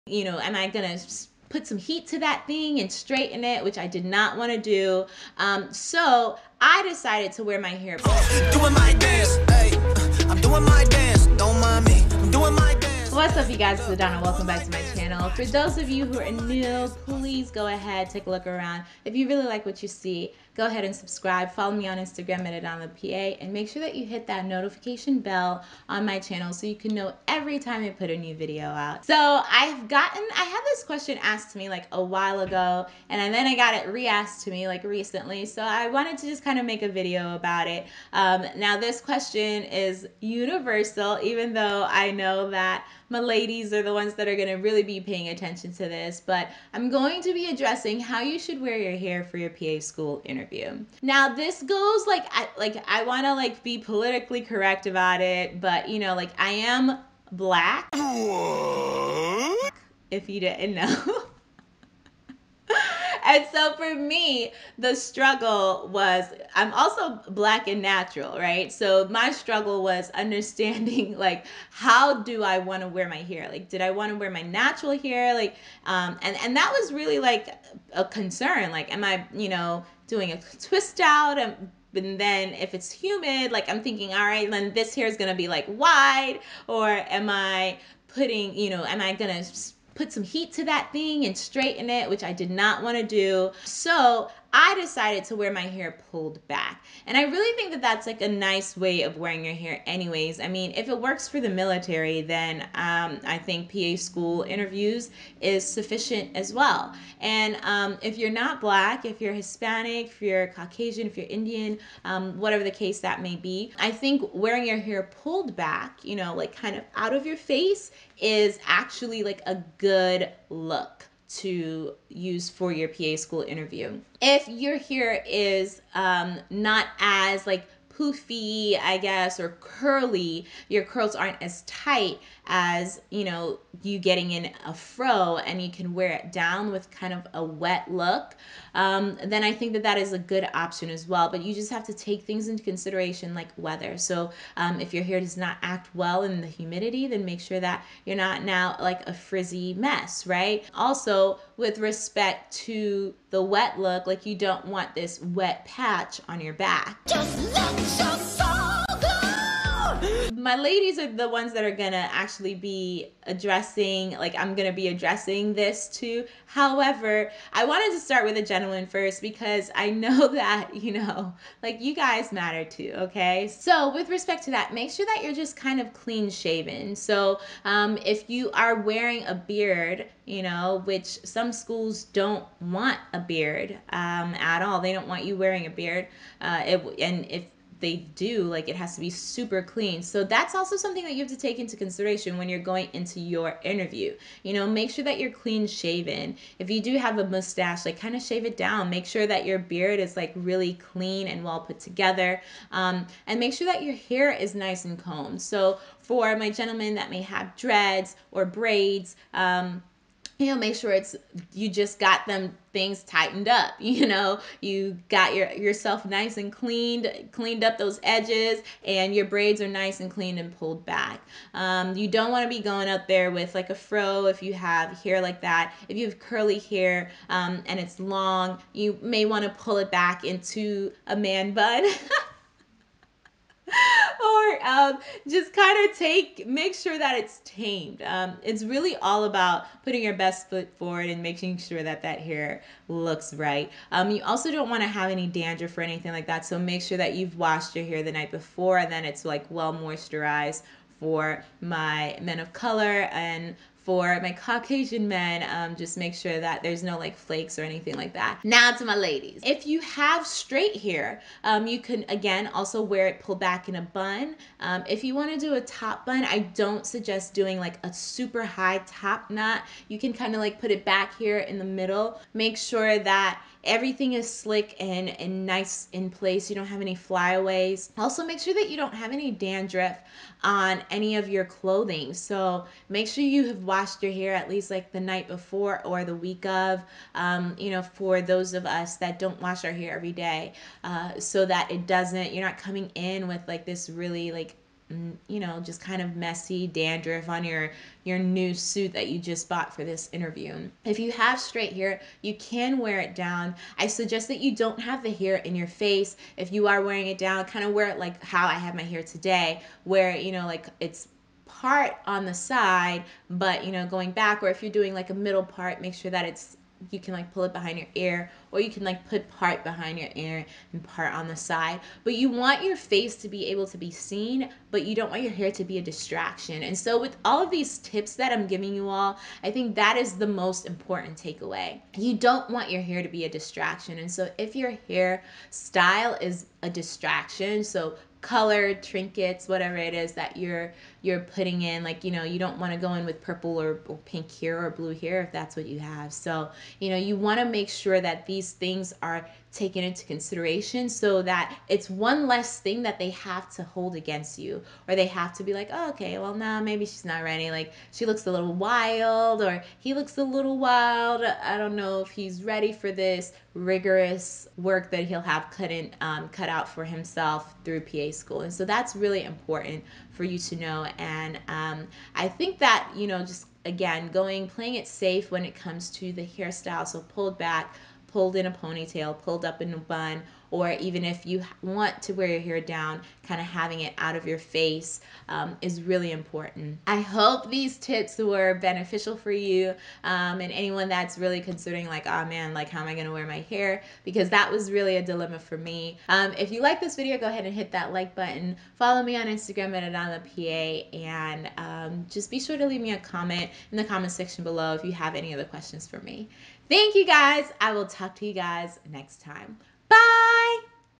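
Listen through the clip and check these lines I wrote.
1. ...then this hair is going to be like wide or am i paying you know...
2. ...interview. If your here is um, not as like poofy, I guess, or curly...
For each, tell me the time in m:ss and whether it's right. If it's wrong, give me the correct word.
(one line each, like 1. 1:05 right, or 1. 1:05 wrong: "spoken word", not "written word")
1. 1:24 wrong: "putting", not "paying"
2. 2:03 right.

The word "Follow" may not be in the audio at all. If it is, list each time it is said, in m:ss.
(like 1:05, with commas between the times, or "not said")
0:21, 6:38.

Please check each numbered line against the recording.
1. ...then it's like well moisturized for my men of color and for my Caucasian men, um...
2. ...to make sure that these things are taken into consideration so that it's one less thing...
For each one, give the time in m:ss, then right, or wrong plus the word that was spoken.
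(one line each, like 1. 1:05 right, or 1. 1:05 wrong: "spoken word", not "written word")
1. 4:08 right
2. 5:47 right.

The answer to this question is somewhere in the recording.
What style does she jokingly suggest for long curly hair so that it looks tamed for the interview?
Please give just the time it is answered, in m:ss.
3:51.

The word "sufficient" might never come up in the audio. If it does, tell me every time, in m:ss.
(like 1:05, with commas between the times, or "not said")
1:45.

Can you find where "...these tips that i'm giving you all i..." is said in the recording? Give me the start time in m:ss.
5:27.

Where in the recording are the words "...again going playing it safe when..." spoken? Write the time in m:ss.
6:13.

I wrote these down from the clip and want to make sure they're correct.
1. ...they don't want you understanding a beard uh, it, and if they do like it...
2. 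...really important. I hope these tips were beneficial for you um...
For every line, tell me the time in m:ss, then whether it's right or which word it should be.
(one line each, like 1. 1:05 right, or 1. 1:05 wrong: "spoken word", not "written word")
1. 3:04 wrong: "wearing", not "understanding"
2. 6:25 right.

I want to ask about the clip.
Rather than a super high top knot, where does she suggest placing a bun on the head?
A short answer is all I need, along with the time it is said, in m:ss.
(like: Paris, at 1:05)
in the middle, at 4:31.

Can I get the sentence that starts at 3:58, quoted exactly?
Um, it's really all about putting your best foot forward and making sure that that hair looks right.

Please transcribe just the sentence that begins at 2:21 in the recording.
But you just have to take things into consideration like weather.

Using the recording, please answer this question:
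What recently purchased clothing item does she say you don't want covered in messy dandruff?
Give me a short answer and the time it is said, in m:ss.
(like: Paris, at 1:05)
new suit, at 4:58.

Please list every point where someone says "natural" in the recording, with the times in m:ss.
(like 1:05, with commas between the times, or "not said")
1:07, 1:14.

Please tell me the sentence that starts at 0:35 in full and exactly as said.
So I wanted to just kind of make a video about it.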